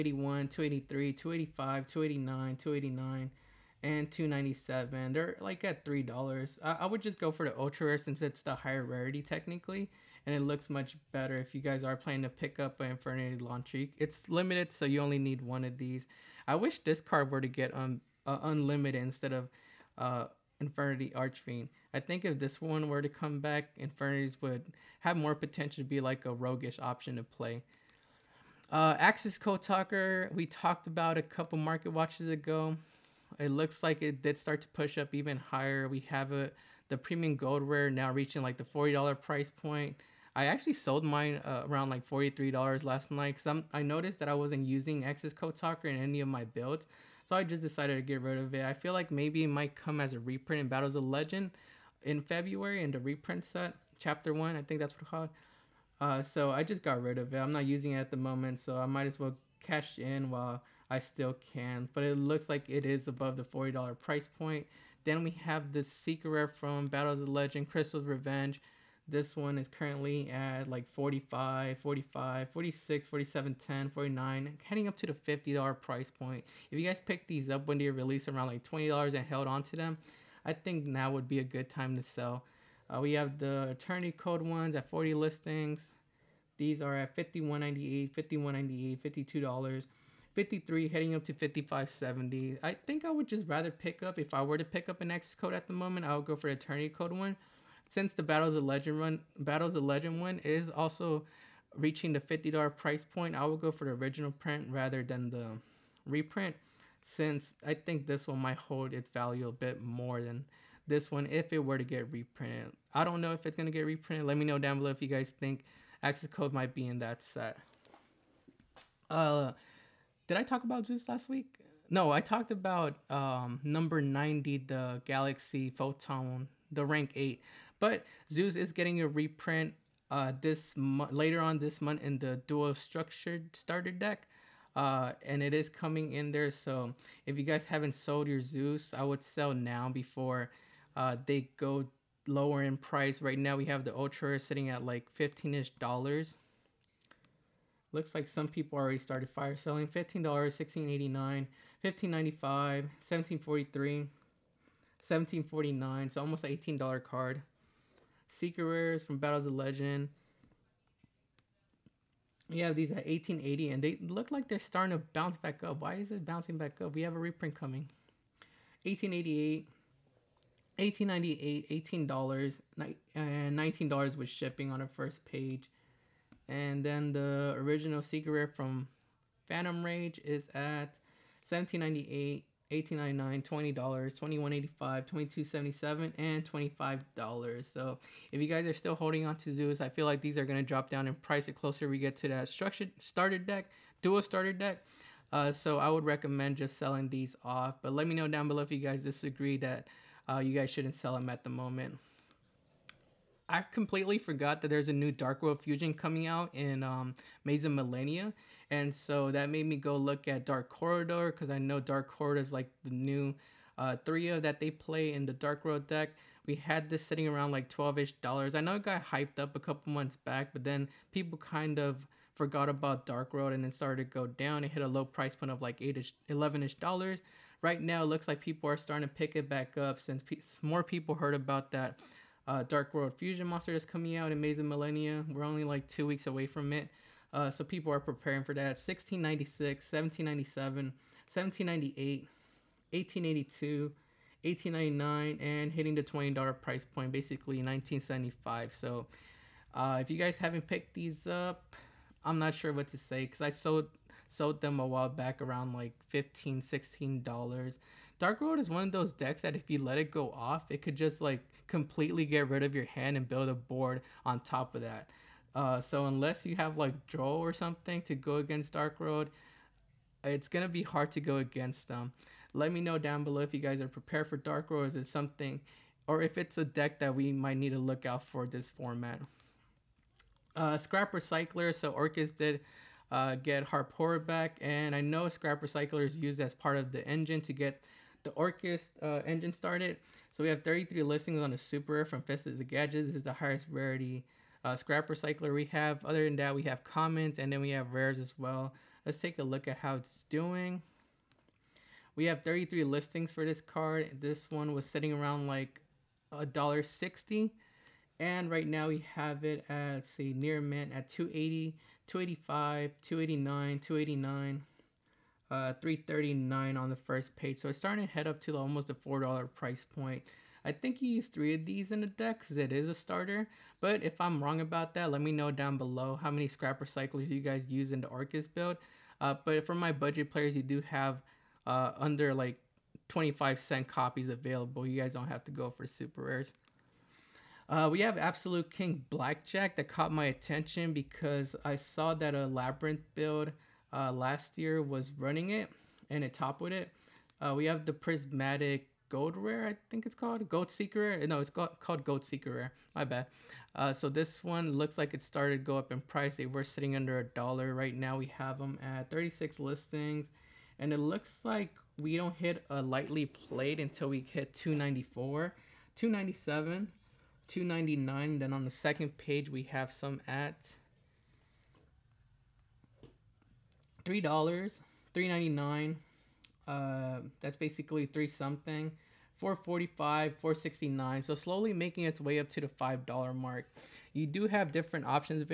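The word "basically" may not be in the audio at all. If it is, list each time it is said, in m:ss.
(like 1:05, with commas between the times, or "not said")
4:07, 6:17.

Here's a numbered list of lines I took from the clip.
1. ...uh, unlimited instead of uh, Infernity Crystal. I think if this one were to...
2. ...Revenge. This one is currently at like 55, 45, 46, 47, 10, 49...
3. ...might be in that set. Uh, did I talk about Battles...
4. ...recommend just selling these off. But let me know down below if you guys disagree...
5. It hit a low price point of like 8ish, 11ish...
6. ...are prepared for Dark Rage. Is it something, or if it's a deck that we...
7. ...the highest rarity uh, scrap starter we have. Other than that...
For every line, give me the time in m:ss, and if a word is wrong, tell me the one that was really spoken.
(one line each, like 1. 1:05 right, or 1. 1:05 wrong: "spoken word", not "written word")
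1. 0:18 wrong: "Archfiend", not "Crystal"
2. 1:08 wrong: "45", not "55"
3. 1:56 wrong: "Zeus", not "Battles"
4. 3:16 right
5. 3:44 right
6. 4:33 wrong: "World", not "Rage"
7. 4:53 wrong: "recycler", not "starter".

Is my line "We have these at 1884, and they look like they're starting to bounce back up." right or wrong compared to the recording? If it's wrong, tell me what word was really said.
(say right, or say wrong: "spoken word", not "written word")
wrong: "1880", not "1884".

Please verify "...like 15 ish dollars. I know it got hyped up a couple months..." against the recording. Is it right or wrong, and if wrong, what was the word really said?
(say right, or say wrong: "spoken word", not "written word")
wrong: "12", not "15".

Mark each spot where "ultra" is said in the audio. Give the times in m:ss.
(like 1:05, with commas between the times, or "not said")
0:07, 2:23.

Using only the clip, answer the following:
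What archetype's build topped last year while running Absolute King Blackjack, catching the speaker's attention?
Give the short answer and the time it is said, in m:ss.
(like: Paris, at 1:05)
Labyrinth, at 5:42.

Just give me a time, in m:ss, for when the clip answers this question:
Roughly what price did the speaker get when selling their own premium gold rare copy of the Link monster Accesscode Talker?
0:42.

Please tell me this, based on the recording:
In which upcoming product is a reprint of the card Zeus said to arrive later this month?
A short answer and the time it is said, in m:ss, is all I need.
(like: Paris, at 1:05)
dual structured starter deck, at 2:12.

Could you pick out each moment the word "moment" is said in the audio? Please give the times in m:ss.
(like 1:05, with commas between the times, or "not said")
0:58, 1:35, 3:21.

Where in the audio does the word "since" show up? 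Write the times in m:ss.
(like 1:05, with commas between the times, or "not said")
0:07, 1:37, 1:47, 3:49.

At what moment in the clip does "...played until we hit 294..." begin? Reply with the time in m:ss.
6:03.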